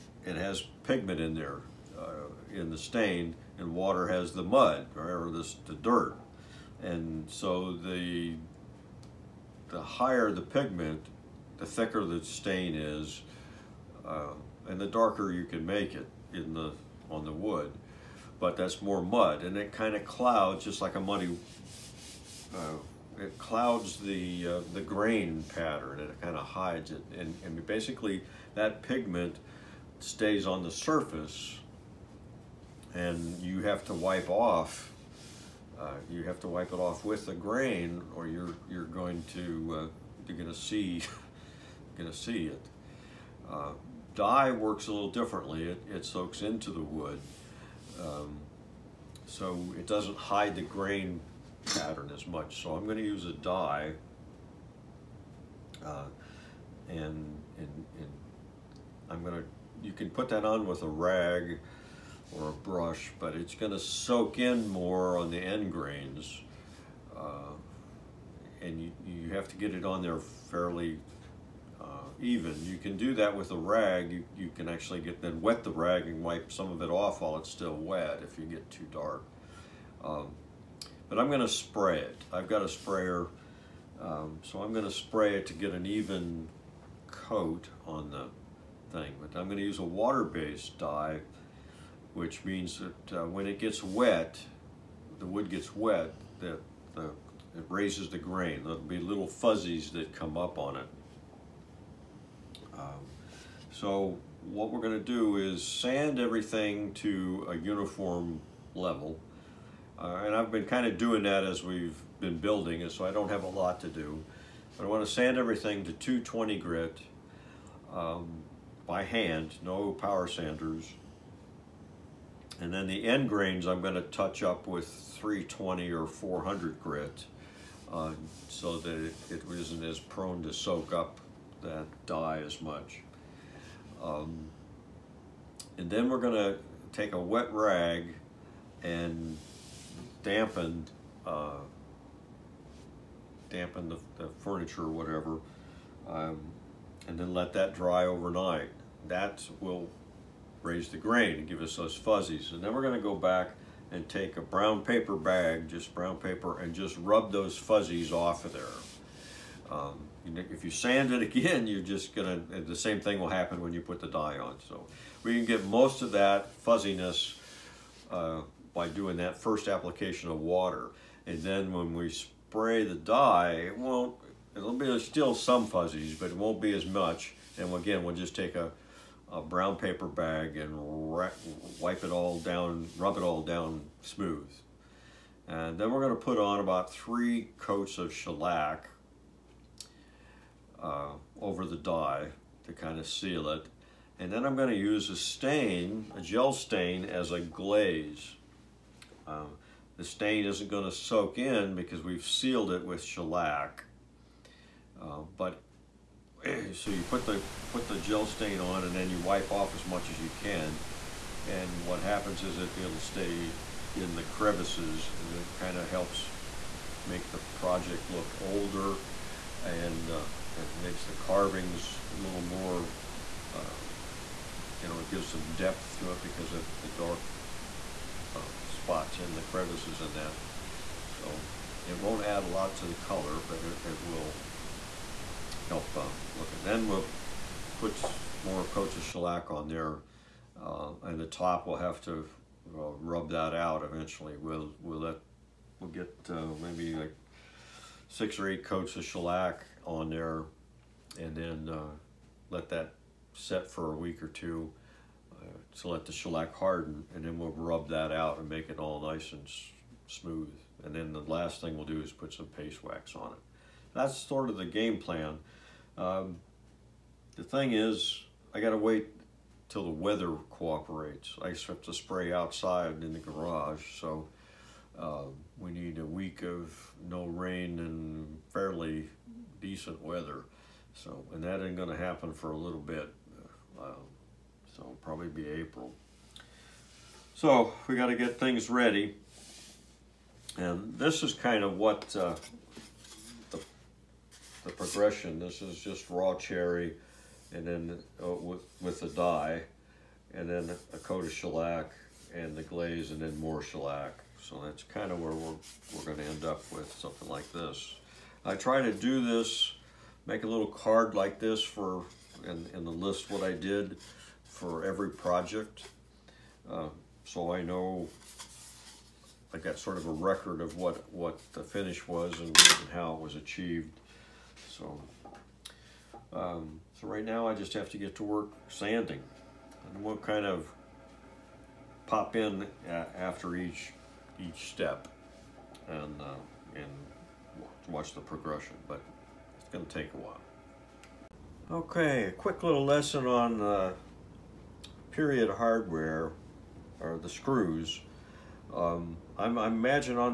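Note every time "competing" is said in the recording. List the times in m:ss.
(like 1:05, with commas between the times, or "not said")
not said.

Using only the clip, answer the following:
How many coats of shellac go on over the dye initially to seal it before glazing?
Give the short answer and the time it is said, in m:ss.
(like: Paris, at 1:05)
3, at 3:06.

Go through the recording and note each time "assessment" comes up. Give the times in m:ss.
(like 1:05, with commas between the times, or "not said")
not said.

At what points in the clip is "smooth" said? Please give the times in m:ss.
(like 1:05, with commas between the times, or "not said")
3:04, 4:20.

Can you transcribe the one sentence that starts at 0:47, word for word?
Um, so it doesn't hide the grain pattern as much.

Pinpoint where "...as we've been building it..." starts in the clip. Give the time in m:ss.
1:51.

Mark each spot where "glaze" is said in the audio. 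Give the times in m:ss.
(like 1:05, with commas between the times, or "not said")
3:17, 5:02.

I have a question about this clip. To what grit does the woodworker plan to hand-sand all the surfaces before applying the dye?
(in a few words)
220.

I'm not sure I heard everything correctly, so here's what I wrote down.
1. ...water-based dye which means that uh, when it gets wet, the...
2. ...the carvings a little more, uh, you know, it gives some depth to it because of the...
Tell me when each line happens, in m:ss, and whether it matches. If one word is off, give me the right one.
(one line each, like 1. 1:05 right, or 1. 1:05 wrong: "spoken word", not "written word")
1. 1:29 right
2. 3:41 right.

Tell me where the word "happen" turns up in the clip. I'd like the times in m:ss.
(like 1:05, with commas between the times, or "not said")
2:43, 3:32, 4:41.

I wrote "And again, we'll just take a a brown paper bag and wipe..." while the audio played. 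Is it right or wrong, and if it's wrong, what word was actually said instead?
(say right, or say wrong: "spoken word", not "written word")
right.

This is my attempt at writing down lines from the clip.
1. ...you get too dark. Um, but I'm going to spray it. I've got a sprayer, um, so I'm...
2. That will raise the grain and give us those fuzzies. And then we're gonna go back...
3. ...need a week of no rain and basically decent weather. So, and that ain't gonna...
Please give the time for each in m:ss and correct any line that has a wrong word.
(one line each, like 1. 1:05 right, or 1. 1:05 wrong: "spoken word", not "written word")
1. 1:18 right
2. 2:29 right
3. 4:35 wrong: "fairly", not "basically".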